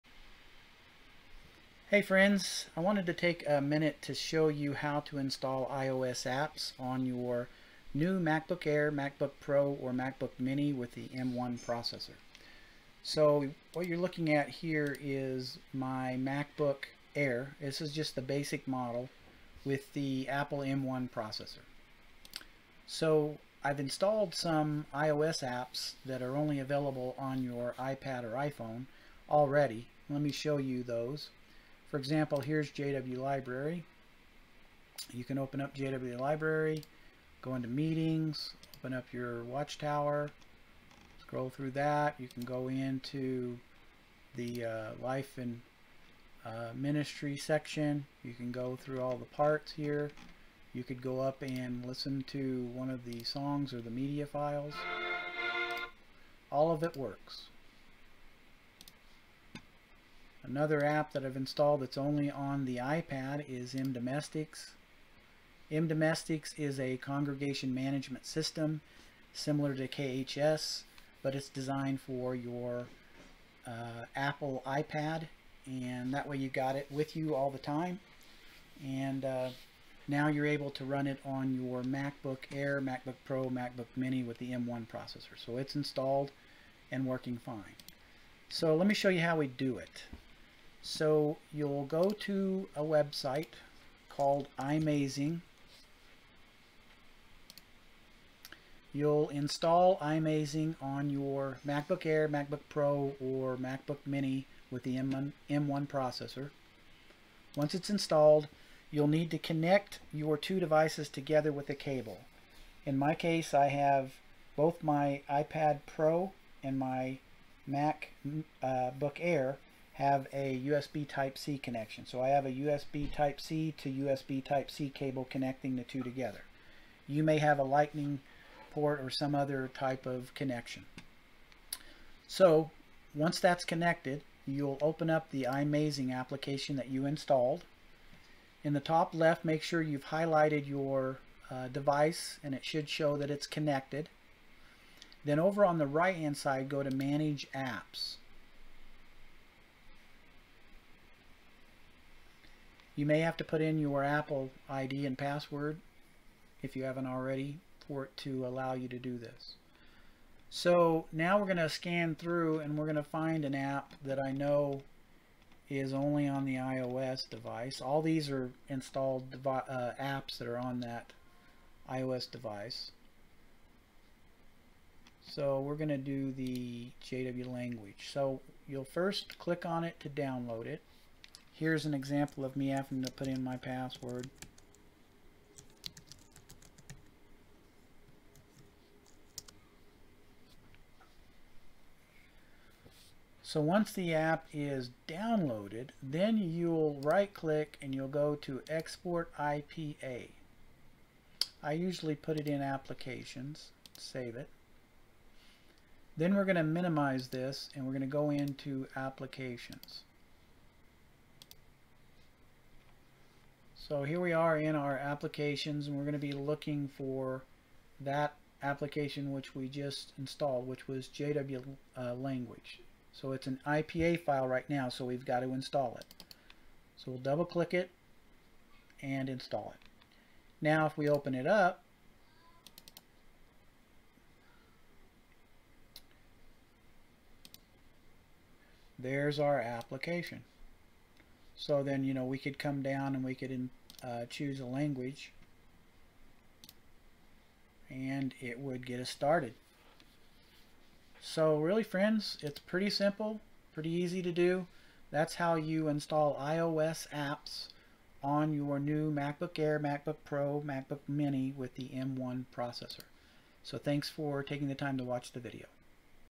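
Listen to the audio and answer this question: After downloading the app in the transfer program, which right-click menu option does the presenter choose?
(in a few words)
Export IPA.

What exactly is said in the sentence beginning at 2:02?
So I have a USB Type-C to USB Type-C cable connecting the two together.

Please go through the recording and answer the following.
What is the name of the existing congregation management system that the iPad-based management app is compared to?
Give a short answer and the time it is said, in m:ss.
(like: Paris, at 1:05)
KHS, at 1:09.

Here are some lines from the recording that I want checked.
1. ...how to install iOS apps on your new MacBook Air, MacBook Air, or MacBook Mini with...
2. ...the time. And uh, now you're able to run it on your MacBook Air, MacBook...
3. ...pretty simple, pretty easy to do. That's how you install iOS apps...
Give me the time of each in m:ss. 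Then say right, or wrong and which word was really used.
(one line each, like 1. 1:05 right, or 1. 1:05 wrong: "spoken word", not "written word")
1. 0:04 wrong: "Pro", not "Air"
2. 1:17 right
3. 4:12 right.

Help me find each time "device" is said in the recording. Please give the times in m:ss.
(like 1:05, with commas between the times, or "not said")
1:50, 2:21, 2:47, 2:52.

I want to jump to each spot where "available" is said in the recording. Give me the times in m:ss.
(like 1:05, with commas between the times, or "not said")
0:26.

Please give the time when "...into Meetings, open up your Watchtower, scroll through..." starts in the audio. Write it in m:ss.
0:37.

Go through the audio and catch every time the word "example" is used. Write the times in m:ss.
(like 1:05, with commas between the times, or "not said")
0:31, 3:01.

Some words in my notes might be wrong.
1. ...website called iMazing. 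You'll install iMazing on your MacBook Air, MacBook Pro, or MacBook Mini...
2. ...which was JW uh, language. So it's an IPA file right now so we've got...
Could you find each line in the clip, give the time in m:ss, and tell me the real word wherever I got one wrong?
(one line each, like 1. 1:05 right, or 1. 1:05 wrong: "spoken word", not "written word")
1. 1:32 right
2. 3:40 right.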